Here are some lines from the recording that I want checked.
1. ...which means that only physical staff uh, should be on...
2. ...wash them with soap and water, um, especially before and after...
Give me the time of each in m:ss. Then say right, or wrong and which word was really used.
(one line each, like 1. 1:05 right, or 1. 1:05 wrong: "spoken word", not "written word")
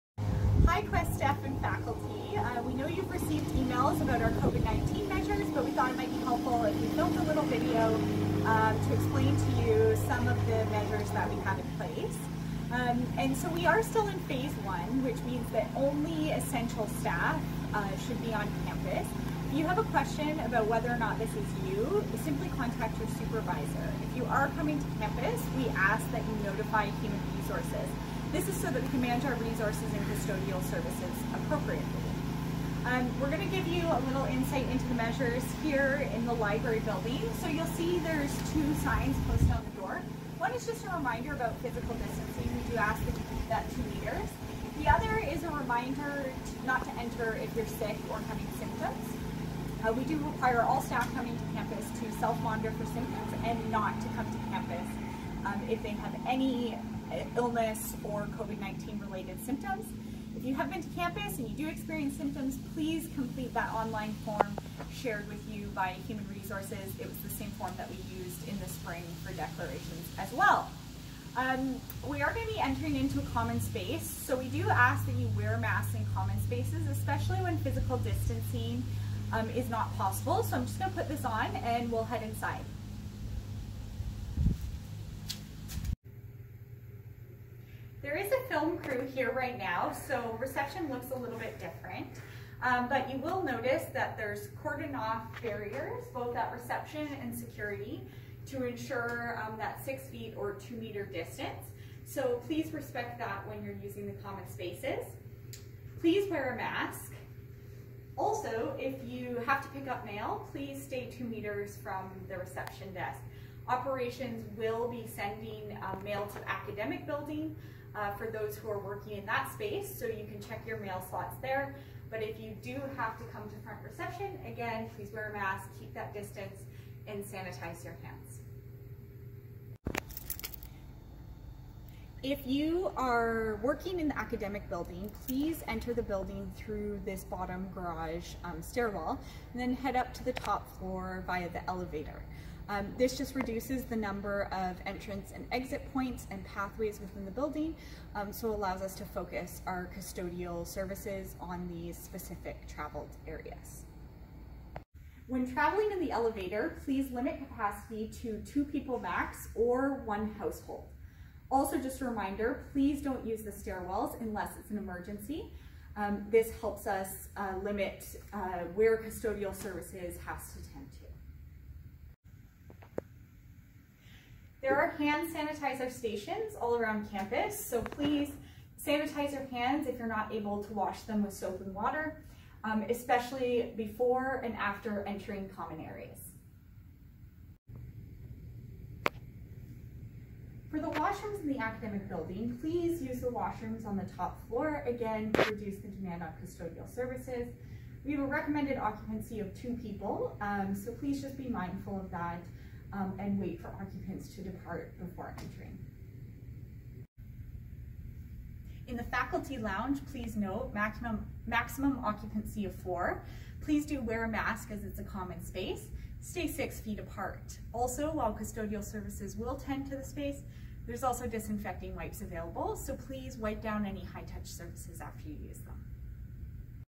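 1. 0:15 wrong: "essential", not "physical"
2. 3:00 right.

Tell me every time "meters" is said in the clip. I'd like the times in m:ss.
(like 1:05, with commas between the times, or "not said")
0:43, 1:40, 1:51.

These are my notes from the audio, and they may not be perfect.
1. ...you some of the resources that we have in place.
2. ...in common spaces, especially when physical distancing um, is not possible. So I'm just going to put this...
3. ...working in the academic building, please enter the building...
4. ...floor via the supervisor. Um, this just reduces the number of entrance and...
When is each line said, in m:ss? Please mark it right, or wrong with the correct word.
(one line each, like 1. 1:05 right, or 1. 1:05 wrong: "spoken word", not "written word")
1. 0:09 wrong: "measures", not "resources"
2. 1:15 right
3. 2:13 right
4. 2:20 wrong: "elevator", not "supervisor".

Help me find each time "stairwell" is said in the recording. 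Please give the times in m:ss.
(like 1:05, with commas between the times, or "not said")
2:18, 2:43.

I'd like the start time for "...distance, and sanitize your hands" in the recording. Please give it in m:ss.
2:06.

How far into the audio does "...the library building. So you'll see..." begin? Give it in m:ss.
0:36.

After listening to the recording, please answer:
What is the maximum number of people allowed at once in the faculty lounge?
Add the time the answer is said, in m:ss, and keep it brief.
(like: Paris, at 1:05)
4, at 3:32.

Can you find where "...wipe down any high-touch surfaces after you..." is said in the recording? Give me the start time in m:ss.
3:43.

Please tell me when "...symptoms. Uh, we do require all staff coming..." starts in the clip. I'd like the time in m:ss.
0:48.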